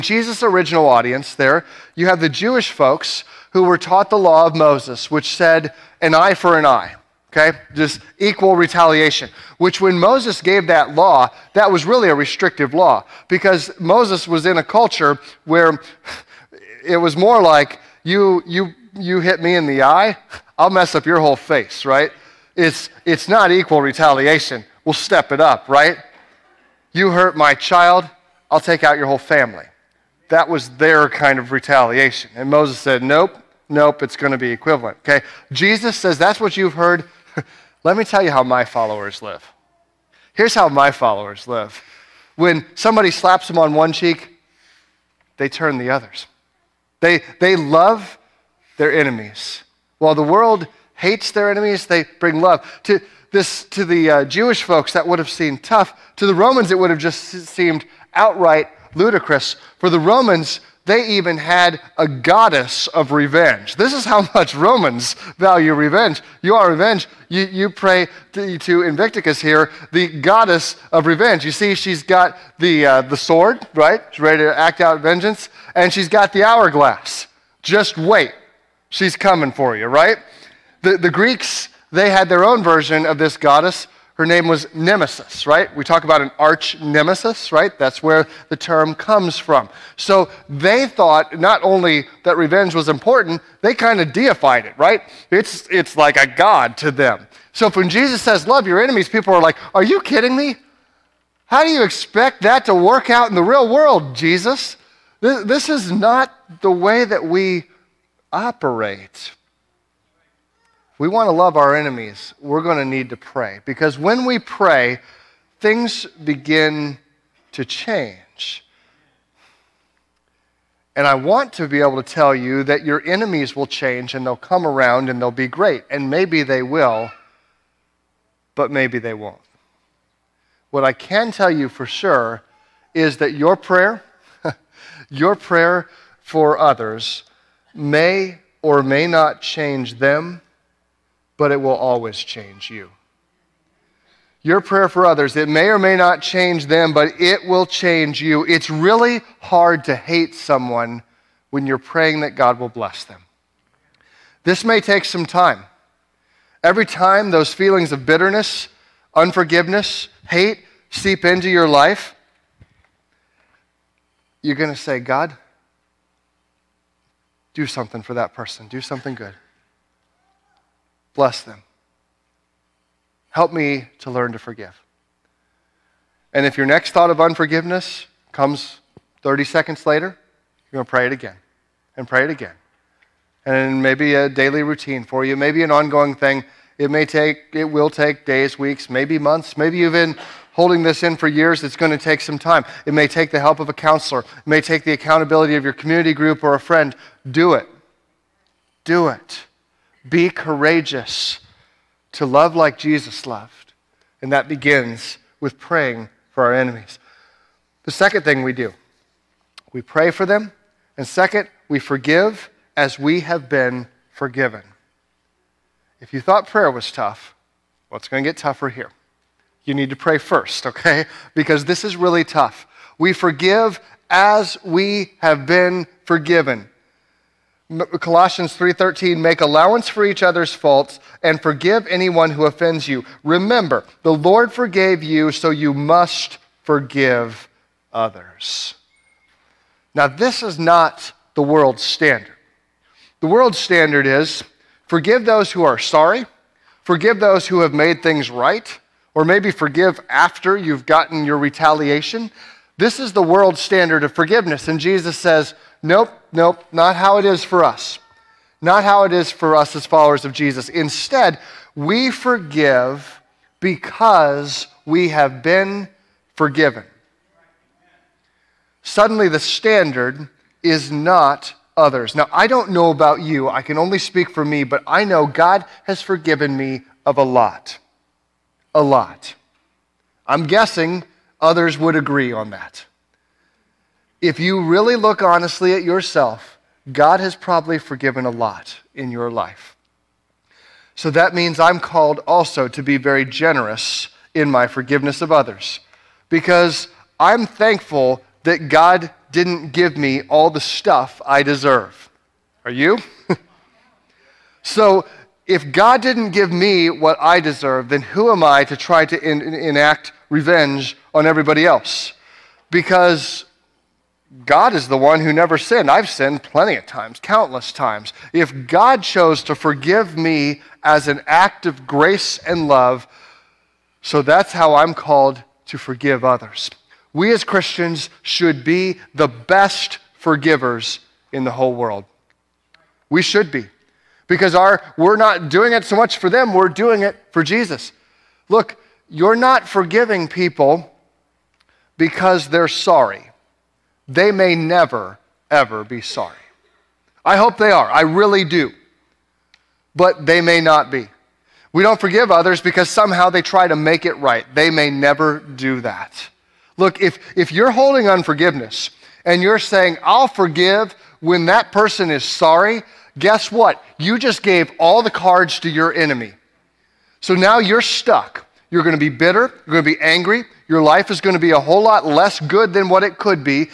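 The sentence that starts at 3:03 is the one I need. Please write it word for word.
And maybe a daily routine for you, maybe an ongoing thing.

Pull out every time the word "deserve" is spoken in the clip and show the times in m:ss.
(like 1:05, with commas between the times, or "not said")
5:01, 5:07.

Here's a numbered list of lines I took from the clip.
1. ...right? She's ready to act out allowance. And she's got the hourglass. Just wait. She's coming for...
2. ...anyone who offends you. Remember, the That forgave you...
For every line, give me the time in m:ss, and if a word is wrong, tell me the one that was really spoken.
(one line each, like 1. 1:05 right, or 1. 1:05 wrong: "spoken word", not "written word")
1. 1:13 wrong: "vengeance", not "allowance"
2. 3:51 wrong: "Lord", not "That".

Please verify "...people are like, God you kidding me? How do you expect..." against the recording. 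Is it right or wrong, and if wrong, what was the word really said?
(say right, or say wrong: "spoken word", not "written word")
wrong: "Are", not "God".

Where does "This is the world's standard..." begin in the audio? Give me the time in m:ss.
4:12.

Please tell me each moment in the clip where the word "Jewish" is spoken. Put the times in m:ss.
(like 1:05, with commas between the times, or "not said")
0:02, 0:54.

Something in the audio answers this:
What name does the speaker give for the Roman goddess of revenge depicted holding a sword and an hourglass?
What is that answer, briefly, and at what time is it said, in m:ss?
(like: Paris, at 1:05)
Invicticus, at 1:08.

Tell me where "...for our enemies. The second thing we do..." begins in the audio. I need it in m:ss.
3:26.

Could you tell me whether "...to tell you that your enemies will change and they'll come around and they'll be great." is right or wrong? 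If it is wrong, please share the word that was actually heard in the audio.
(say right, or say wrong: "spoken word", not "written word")
right.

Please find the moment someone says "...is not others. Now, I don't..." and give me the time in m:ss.
4:30.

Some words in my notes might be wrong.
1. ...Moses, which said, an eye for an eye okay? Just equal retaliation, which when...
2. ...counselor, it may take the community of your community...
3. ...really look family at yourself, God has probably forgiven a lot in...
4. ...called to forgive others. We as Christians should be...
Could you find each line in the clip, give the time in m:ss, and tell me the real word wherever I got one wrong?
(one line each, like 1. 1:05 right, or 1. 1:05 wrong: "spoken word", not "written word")
1. 0:04 right
2. 3:13 wrong: "accountability", not "community"
3. 4:44 wrong: "honestly", not "family"
4. 5:24 right.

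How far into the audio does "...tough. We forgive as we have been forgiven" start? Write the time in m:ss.
3:42.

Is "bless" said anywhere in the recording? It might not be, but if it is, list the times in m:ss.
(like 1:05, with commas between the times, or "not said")
2:32, 2:51.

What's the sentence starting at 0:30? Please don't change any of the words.
That was their kind of retaliation.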